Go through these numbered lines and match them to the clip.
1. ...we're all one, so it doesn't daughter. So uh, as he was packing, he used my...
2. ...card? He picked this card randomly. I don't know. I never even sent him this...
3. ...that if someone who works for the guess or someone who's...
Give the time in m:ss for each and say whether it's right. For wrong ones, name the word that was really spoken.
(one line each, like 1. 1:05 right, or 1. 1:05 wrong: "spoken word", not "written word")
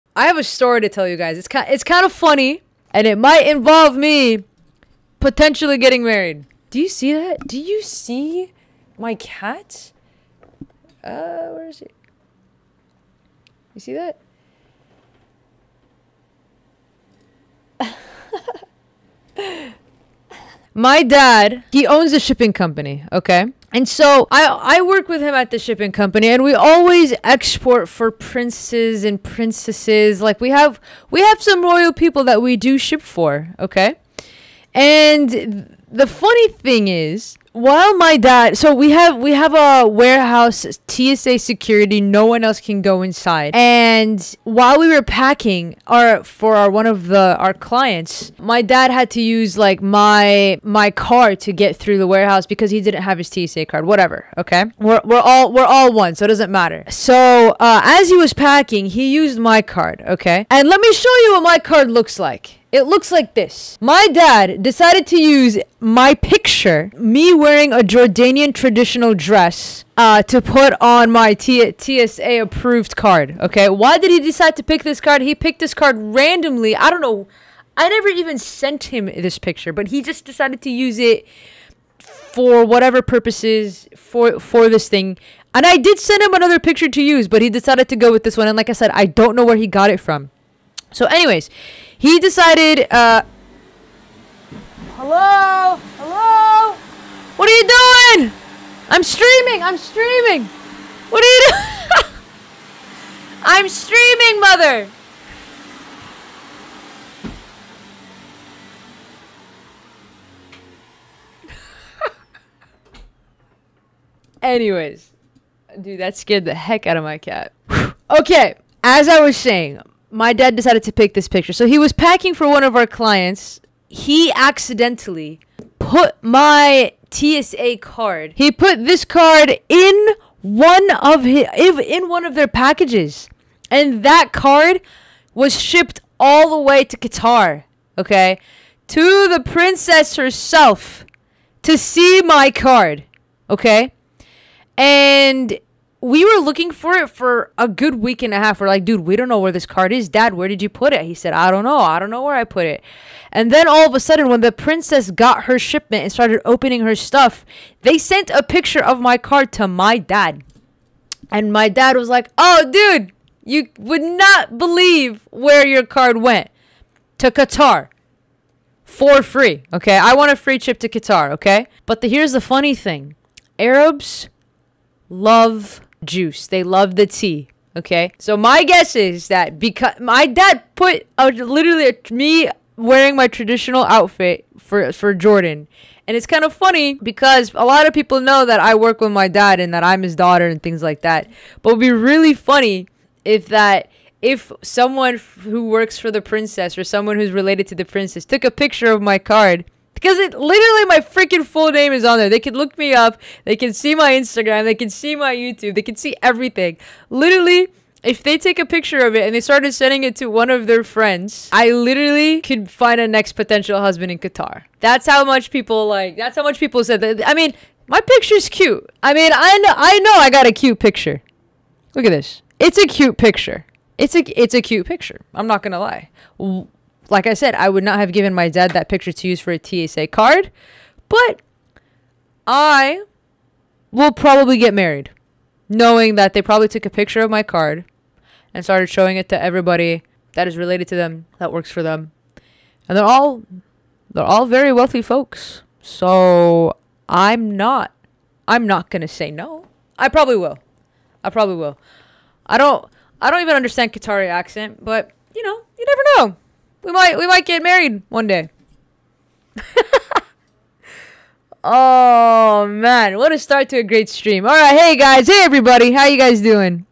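1. 0:55 wrong: "matter", not "daughter"
2. 1:15 right
3. 3:13 wrong: "princess", not "guess".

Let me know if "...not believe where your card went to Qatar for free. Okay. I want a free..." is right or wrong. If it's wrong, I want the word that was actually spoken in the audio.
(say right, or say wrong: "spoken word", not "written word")
right.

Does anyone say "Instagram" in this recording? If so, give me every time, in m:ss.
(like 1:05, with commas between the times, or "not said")
3:24.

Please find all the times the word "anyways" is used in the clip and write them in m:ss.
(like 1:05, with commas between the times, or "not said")
1:31, 1:54.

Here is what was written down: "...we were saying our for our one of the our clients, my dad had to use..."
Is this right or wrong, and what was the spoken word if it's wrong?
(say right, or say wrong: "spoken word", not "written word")
wrong: "packing", not "saying".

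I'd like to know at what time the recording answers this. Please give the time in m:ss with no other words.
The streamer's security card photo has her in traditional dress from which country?
1:07.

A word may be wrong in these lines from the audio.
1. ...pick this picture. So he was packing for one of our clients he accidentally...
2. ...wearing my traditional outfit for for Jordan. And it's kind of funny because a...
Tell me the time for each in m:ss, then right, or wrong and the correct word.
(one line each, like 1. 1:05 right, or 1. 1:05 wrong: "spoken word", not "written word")
1. 2:00 right
2. 3:02 right.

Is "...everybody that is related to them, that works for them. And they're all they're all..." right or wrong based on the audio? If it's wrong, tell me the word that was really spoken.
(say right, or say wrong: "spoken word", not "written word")
right.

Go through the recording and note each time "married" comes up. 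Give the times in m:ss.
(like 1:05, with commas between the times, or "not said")
0:06, 3:54, 4:17.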